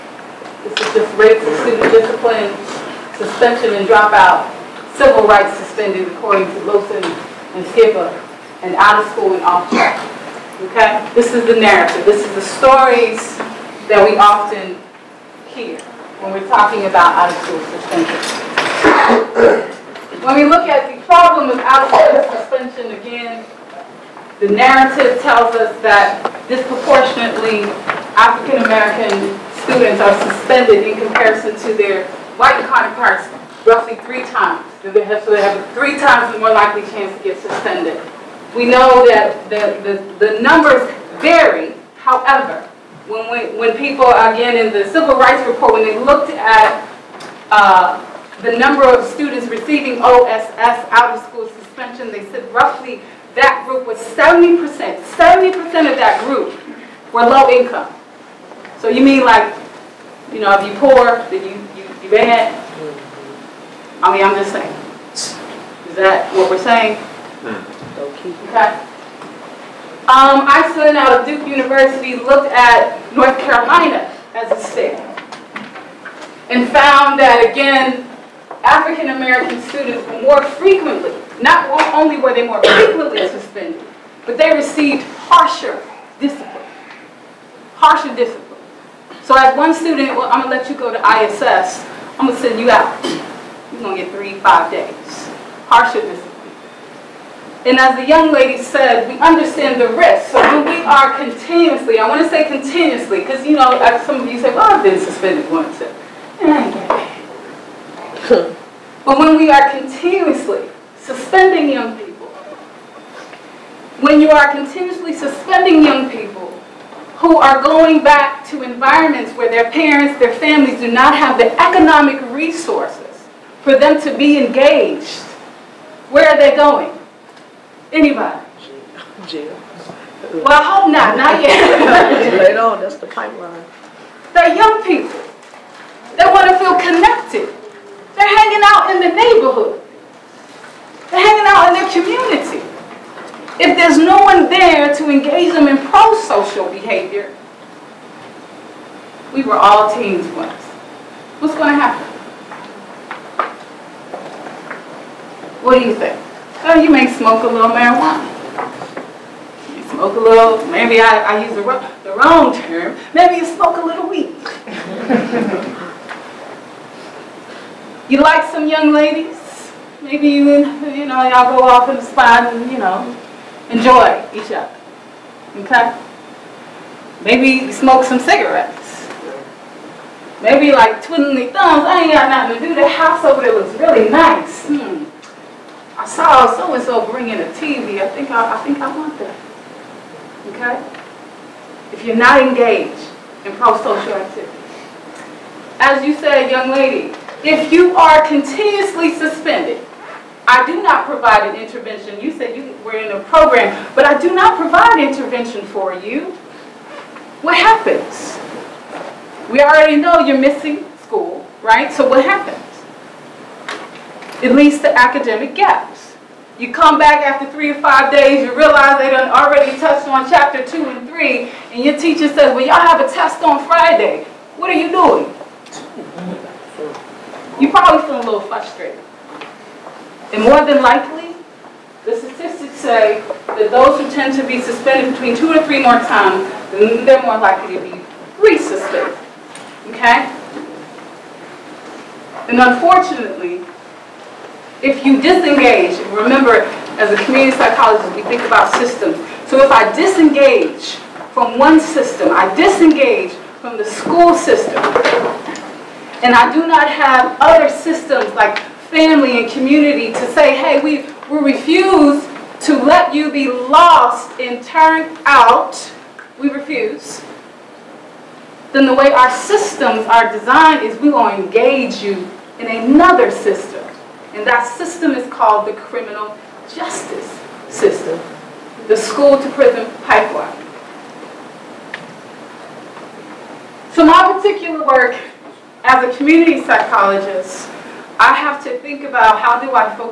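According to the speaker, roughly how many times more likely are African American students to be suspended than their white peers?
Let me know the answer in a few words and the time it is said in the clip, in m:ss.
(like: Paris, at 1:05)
3 times, at 0:33.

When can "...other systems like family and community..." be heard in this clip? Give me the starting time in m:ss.
4:17.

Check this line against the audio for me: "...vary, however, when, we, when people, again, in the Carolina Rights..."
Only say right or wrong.
wrong.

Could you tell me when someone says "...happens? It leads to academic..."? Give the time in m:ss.
3:32.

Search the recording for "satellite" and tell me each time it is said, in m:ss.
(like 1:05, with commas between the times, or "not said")
not said.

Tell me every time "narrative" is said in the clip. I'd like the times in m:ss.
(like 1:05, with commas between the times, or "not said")
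0:11, 0:24.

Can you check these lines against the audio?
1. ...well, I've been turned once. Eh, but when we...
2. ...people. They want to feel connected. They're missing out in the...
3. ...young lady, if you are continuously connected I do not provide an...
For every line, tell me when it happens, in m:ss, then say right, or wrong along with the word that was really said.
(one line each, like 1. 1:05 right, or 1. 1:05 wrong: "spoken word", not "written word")
1. 1:44 wrong: "suspended", not "turned"
2. 2:14 wrong: "hanging", not "missing"
3. 3:16 wrong: "suspended", not "connected".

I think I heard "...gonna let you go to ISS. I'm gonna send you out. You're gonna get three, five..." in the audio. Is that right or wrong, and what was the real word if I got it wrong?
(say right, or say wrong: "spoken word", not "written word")
right.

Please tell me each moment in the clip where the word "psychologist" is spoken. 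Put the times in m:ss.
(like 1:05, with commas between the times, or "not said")
4:07, 4:46.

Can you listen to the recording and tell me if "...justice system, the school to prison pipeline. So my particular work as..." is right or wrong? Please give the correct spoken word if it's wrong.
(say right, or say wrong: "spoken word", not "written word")
right.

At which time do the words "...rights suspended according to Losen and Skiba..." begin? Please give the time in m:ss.
0:05.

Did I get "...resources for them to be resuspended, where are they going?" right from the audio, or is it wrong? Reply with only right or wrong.
wrong.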